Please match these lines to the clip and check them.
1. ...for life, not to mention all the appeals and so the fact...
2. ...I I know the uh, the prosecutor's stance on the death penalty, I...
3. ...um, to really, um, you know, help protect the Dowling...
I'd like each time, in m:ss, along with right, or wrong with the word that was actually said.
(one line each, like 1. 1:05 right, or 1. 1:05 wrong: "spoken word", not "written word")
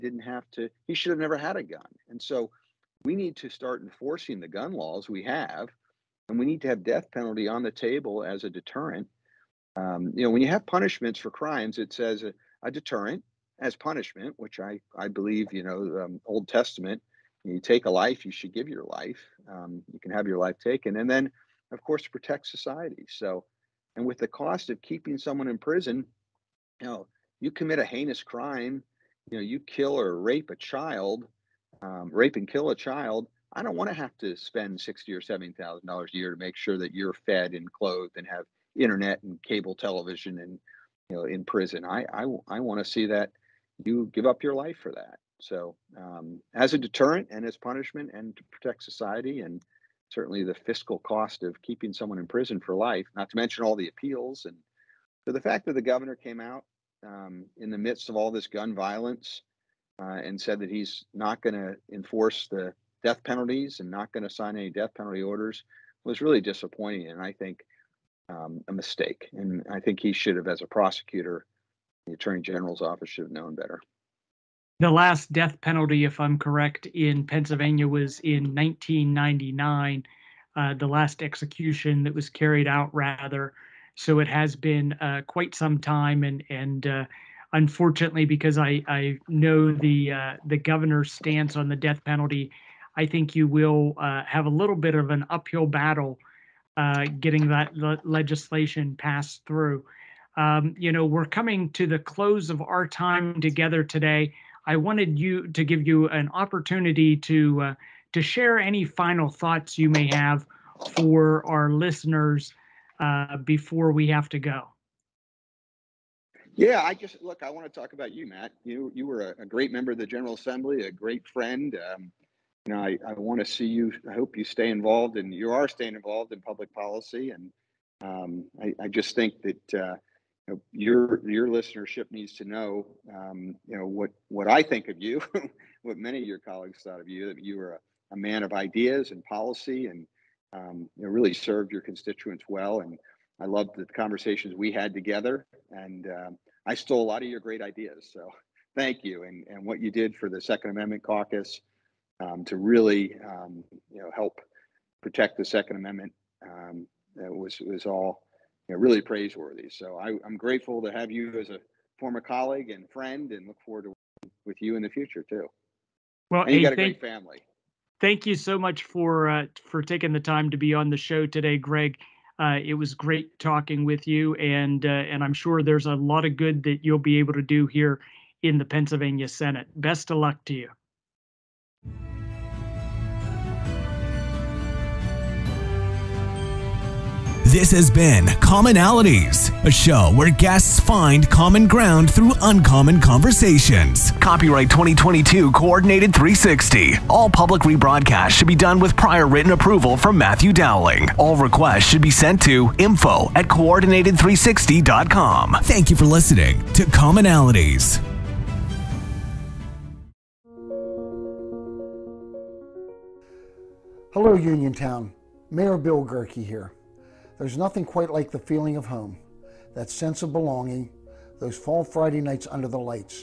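1. 0:52 right
2. 1:28 wrong: "governor", not "prosecutor"
3. 2:32 wrong: "Second", not "Dowling".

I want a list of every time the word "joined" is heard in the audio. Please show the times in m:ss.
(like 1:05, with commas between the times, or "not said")
not said.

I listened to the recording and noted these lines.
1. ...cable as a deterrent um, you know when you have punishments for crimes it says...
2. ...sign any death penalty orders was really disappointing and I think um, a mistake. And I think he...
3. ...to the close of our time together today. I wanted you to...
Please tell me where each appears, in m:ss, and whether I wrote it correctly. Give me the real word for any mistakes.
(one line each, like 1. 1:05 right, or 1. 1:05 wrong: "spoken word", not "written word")
1. 0:07 wrong: "table", not "cable"
2. 1:04 right
3. 1:41 right.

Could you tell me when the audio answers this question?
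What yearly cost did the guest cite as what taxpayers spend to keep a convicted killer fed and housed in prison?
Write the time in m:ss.
0:34.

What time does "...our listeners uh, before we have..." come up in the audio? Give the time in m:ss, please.
1:51.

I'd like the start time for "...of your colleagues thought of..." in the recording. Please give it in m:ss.
2:16.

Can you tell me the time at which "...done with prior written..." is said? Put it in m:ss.
3:18.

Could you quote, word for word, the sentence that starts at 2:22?
And I loved the conversations we had together.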